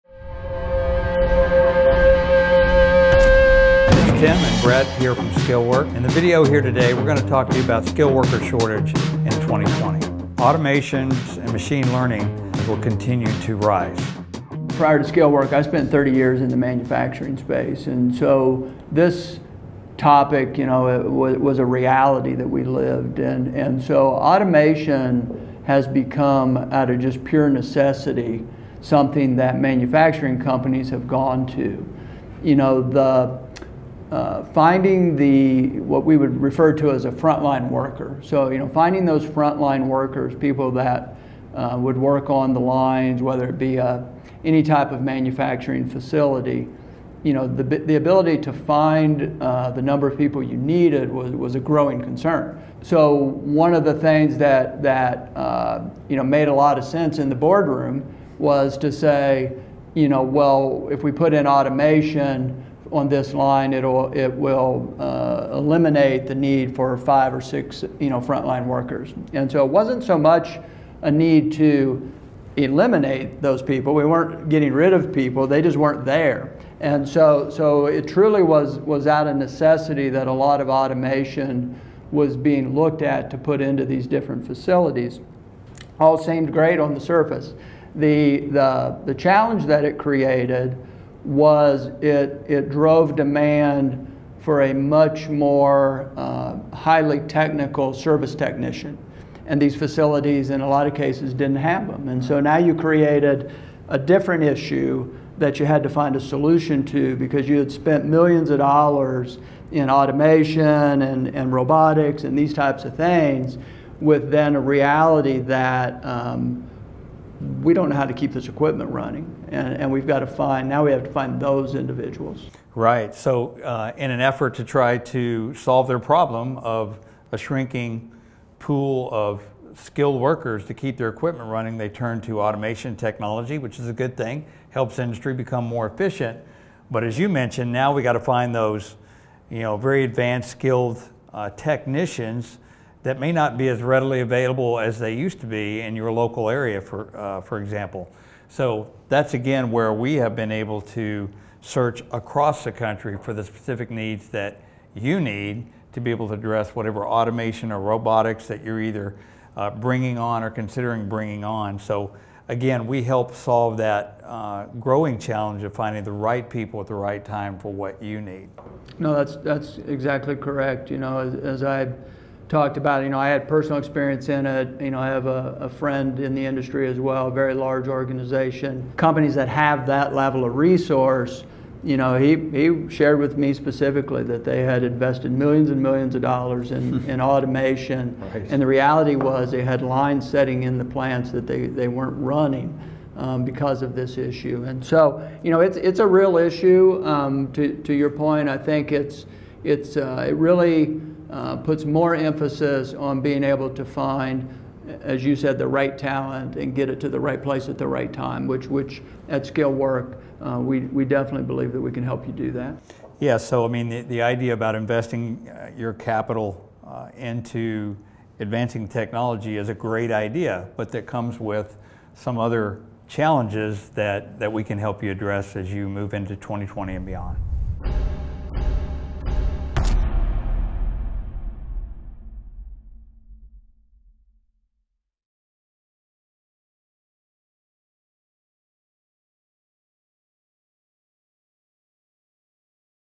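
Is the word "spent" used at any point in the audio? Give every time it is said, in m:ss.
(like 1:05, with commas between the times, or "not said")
0:15, 1:47.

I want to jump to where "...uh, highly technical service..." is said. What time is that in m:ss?
1:36.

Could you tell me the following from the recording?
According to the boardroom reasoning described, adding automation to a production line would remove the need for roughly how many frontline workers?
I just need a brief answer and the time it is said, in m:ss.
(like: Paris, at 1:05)
5 or 6, at 1:06.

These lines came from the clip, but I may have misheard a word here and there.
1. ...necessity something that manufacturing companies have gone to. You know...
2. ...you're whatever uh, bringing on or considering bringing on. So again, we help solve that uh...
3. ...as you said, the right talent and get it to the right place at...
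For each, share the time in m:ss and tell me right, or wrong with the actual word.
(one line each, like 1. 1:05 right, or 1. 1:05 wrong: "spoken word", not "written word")
1. 0:27 right
2. 2:38 wrong: "either", not "whatever"
3. 3:25 right.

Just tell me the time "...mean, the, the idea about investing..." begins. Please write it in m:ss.
3:33.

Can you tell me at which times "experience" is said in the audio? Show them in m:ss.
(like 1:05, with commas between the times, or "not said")
2:53.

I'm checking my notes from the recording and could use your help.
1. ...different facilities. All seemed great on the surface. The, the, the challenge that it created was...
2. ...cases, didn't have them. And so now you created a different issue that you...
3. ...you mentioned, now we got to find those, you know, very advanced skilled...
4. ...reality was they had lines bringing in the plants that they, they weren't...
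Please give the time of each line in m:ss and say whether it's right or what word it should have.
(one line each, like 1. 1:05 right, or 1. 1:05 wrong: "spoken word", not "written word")
1. 1:24 right
2. 1:40 right
3. 2:17 right
4. 3:08 wrong: "setting", not "bringing".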